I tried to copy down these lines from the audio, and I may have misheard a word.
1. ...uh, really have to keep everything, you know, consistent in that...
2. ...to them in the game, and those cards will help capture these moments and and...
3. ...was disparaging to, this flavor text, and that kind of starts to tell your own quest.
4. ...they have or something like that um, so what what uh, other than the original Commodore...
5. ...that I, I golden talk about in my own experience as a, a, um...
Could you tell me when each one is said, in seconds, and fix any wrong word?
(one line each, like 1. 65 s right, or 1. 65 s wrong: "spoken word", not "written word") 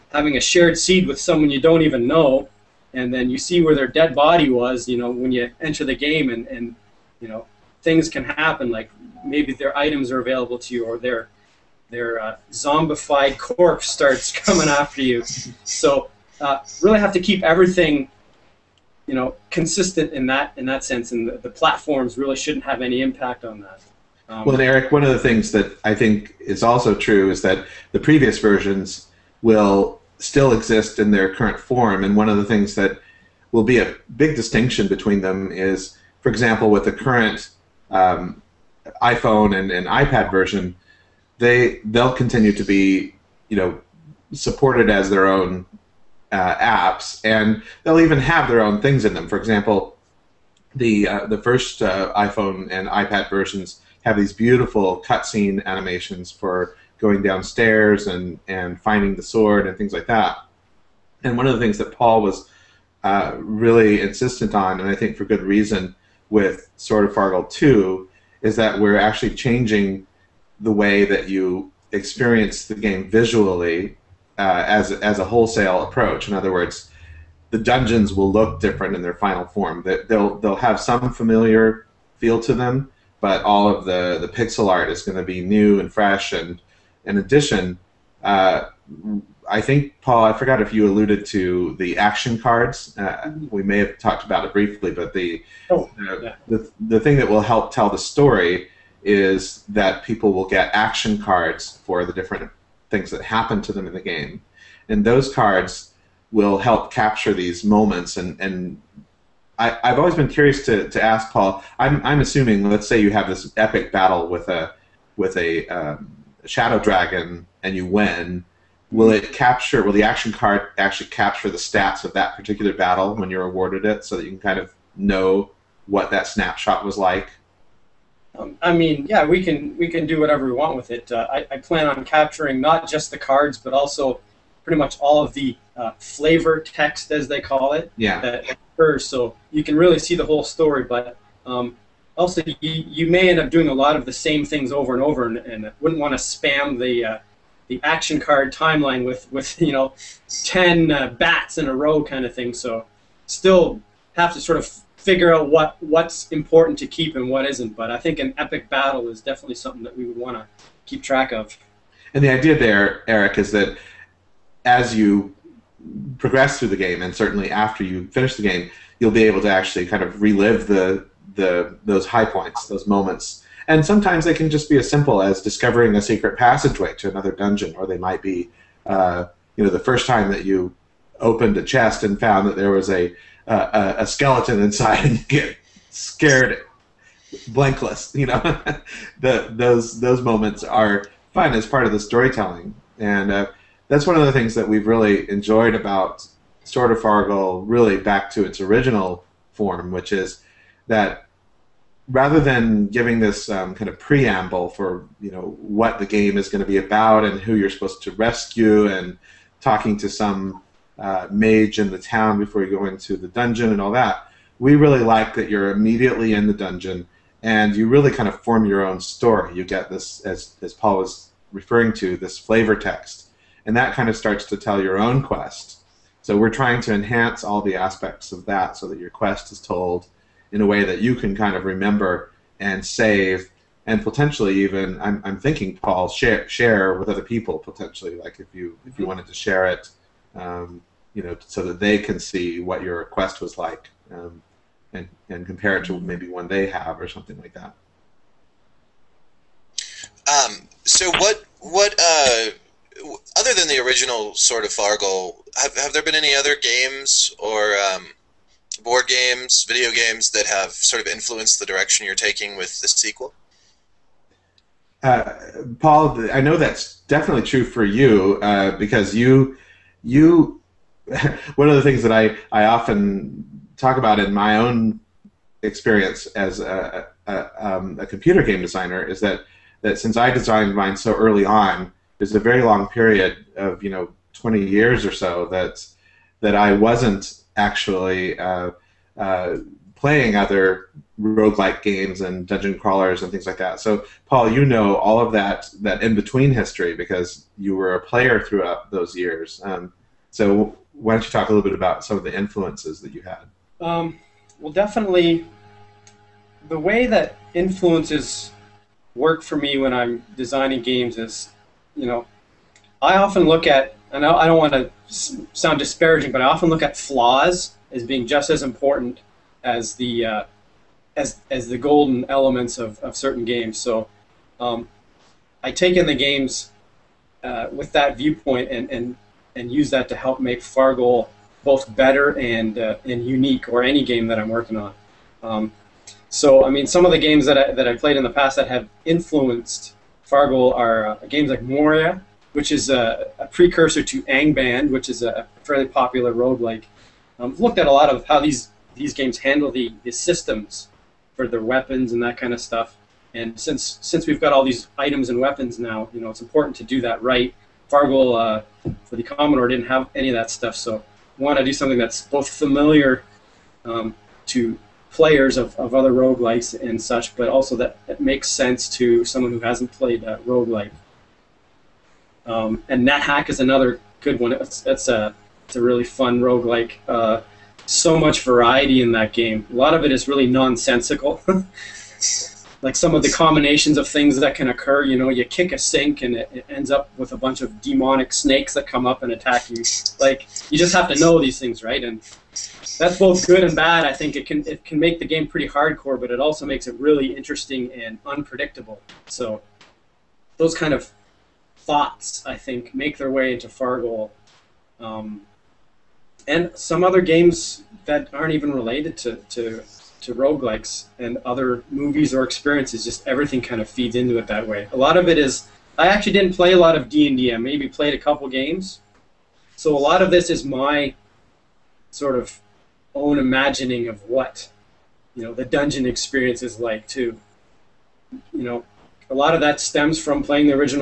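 1. 16 s right
2. 103 s right
3. 220 s wrong: "referring", not "disparaging"
4. 246 s wrong: "Sword", not "Commodore"
5. 272 s wrong: "often", not "golden".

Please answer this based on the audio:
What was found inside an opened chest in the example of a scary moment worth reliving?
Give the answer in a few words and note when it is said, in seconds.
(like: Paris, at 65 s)
a skeleton, at 184 s.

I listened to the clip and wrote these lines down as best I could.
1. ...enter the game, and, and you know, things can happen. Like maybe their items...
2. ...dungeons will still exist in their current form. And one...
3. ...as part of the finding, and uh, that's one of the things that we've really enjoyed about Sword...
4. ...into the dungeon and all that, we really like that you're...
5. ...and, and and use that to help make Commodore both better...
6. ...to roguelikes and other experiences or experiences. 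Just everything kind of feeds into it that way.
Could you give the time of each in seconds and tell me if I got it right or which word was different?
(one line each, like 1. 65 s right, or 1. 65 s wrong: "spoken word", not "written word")
1. 5 s right
2. 28 s wrong: "versions", not "dungeons"
3. 191 s wrong: "storytelling", not "finding"
4. 212 s right
5. 328 s wrong: "Fargoal", not "Commodore"
6. 410 s wrong: "movies", not "experiences".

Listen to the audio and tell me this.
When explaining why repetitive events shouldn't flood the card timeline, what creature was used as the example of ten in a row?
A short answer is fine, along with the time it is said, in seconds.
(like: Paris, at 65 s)
bats, at 151 s.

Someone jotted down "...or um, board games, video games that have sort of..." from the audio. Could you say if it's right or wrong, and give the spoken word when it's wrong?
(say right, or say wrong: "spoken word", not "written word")
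right.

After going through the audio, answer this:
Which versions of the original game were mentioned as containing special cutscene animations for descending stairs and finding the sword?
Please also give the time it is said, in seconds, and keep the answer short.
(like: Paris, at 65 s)
iPhone and iPad, at 52 s.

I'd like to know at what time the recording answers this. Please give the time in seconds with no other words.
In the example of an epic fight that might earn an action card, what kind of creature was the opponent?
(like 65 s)
116 s.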